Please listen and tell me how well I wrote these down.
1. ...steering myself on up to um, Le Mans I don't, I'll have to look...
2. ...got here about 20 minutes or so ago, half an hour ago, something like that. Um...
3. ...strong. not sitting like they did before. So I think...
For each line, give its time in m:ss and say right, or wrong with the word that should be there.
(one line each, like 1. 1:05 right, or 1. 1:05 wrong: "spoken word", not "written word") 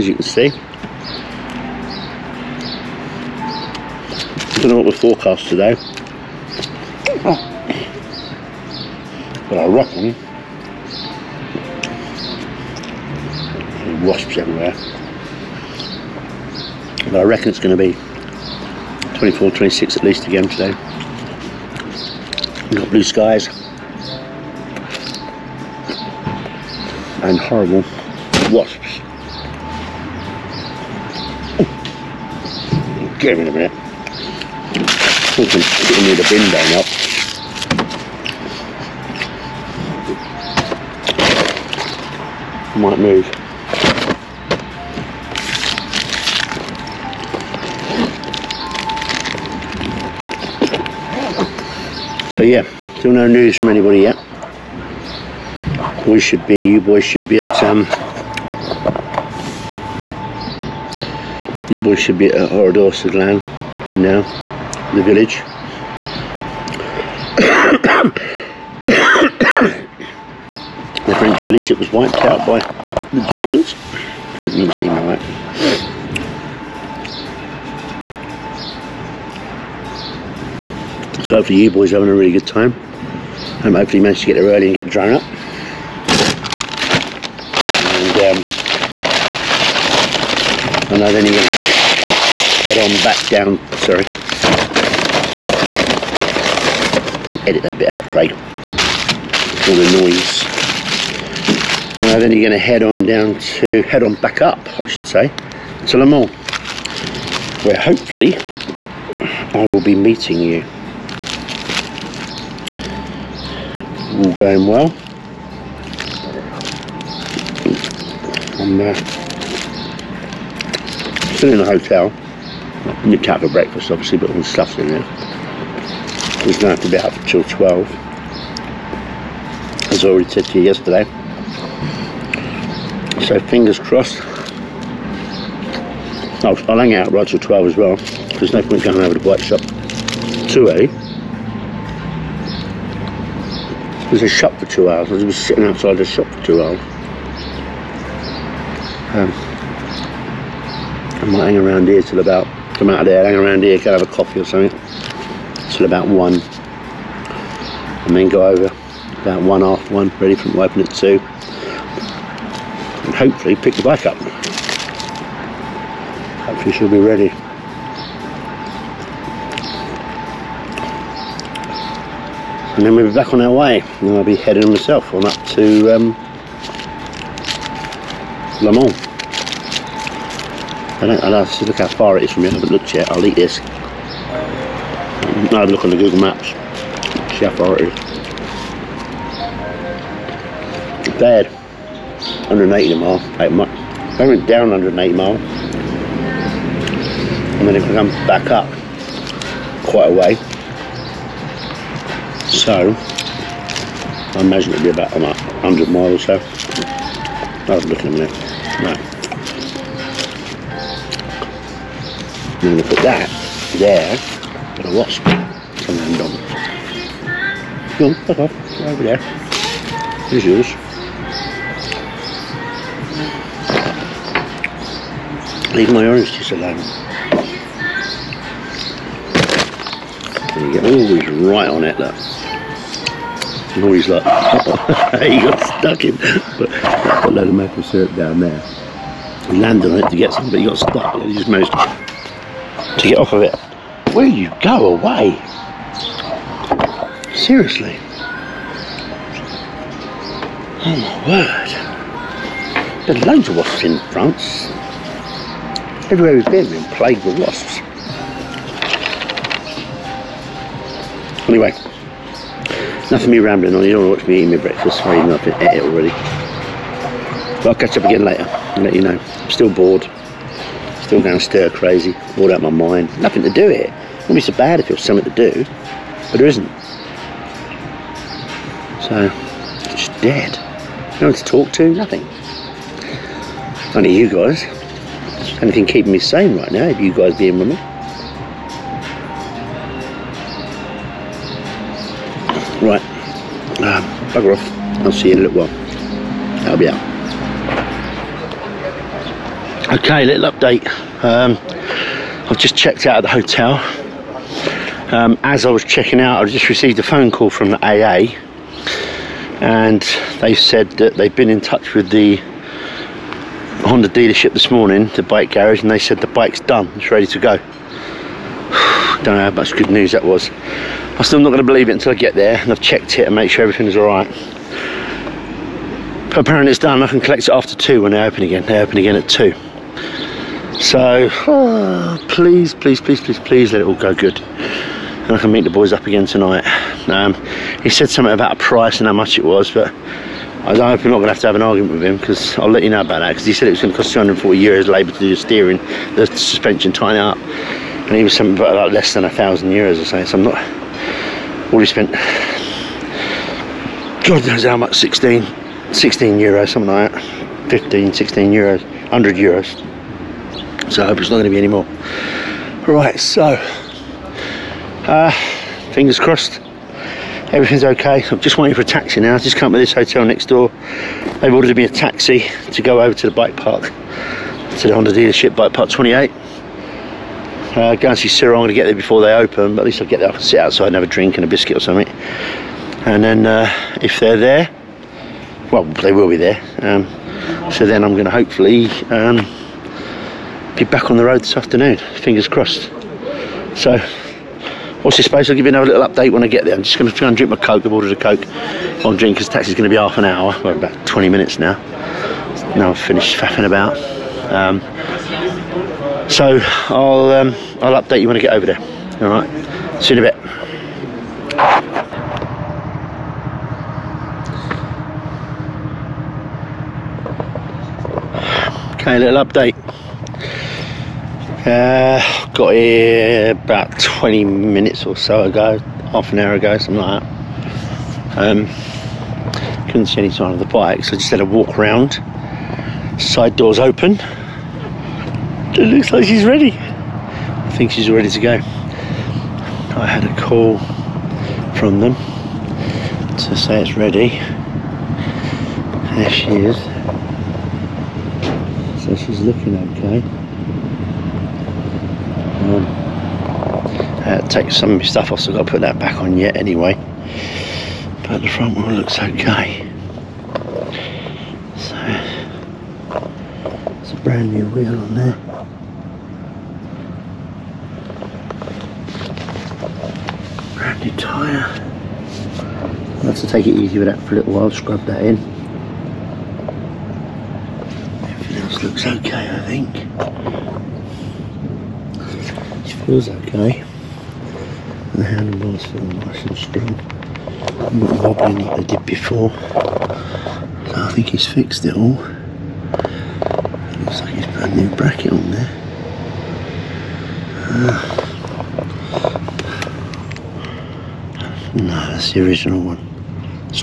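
1. 2:54 wrong: "heading", not "steering"
2. 7:02 right
3. 8:06 wrong: "wobbling", not "sitting".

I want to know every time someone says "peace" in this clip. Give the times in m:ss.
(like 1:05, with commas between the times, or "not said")
not said.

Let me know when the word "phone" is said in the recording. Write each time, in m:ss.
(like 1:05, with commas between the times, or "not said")
5:07.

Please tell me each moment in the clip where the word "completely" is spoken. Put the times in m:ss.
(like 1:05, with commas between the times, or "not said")
not said.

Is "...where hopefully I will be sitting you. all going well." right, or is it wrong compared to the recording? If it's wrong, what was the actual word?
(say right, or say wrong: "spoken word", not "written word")
wrong: "meeting", not "sitting".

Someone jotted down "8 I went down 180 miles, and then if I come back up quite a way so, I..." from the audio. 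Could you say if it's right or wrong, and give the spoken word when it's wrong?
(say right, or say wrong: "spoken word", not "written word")
right.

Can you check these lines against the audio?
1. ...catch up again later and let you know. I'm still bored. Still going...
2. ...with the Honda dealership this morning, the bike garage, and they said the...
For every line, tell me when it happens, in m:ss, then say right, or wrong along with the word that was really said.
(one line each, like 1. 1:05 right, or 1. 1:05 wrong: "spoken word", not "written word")
1. 4:27 right
2. 5:11 right.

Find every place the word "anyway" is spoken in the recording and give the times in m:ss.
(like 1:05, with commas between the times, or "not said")
4:21, 7:36.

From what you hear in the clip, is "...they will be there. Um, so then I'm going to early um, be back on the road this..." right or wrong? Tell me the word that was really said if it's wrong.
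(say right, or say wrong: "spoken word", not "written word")
wrong: "hopefully", not "early".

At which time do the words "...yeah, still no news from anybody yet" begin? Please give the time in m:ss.
0:52.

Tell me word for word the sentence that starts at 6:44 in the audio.
Um, so I'll um, I'll update you when I get over there.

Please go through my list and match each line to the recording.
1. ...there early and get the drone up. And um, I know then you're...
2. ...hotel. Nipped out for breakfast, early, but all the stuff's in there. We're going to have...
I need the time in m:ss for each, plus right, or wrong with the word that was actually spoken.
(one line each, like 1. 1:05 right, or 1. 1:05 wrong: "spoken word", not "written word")
1. 1:24 right
2. 2:01 wrong: "obviously", not "early".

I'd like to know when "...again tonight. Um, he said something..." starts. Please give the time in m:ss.
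5:36.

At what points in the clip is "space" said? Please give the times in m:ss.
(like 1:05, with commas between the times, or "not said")
6:35.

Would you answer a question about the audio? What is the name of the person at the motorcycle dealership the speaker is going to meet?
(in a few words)
Cyril.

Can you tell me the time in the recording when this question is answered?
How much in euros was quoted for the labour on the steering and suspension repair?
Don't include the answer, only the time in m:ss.
5:44.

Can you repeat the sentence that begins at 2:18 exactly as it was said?
There's no point going over to the bike shop too early was a shop for two hours.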